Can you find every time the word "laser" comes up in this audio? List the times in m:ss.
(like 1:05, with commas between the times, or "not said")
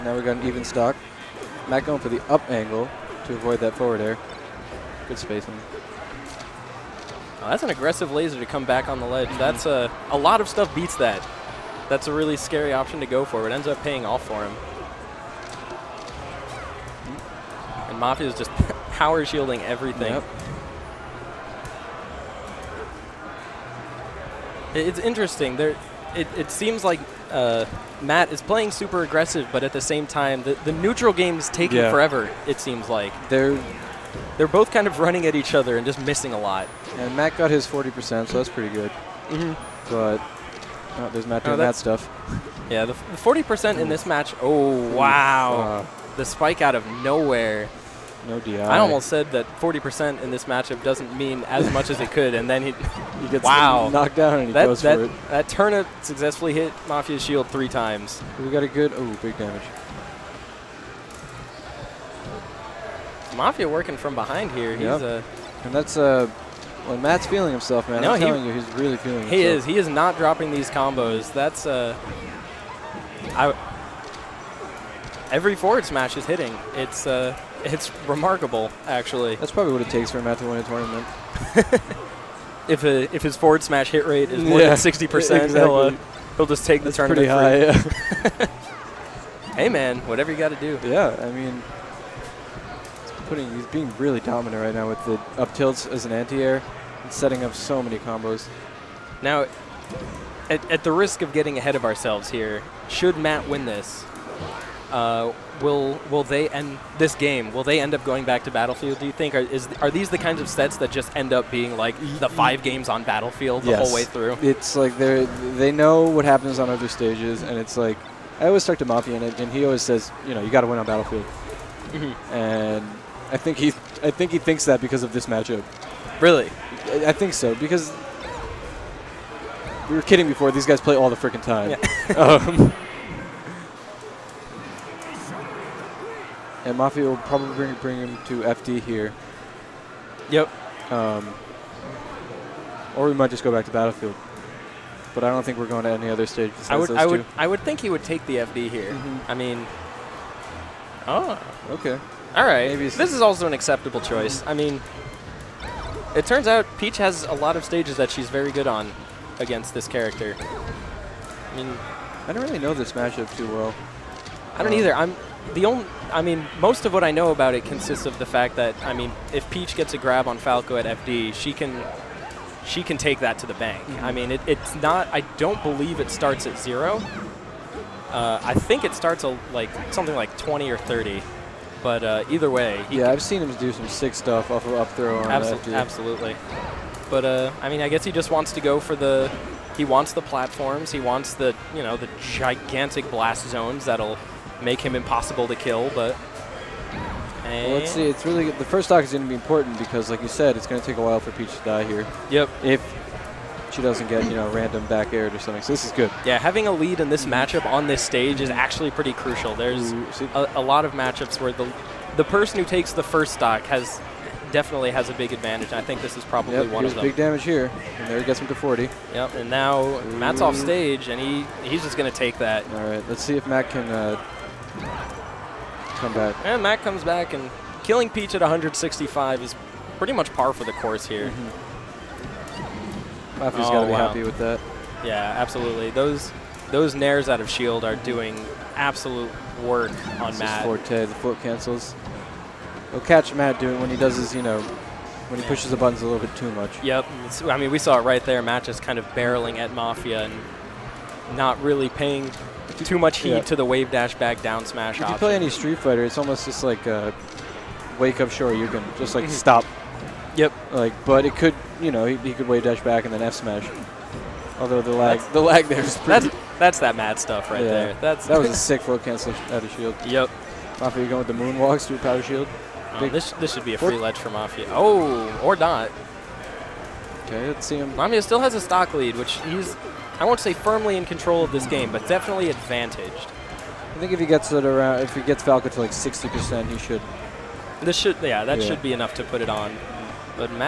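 0:08.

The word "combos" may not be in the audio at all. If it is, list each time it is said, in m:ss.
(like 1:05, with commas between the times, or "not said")
1:10, 1:37.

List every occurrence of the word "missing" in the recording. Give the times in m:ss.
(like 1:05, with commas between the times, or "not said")
0:36.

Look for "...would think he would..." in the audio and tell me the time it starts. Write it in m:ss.
2:27.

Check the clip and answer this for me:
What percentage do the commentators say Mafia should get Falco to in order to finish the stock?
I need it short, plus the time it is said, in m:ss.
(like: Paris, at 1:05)
60%, at 4:45.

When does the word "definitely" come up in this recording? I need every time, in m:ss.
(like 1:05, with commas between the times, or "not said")
3:34, 4:42.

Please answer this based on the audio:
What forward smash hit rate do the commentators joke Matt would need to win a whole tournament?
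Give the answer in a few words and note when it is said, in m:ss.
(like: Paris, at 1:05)
60%, at 1:24.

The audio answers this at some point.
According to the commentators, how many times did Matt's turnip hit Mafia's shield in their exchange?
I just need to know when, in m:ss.
0:57.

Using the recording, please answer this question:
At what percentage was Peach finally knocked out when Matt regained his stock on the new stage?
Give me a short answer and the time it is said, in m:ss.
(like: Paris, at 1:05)
165, at 3:48.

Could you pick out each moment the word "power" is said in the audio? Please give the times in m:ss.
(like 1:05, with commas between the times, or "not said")
0:18, 4:32.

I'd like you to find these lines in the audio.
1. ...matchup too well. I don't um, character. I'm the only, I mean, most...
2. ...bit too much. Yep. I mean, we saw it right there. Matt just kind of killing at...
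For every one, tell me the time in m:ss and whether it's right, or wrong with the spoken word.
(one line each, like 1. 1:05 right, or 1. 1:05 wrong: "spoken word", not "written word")
1. 2:42 wrong: "either", not "character"
2. 4:06 wrong: "barreling", not "killing".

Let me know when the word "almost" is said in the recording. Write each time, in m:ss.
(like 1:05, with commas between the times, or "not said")
0:48, 4:16.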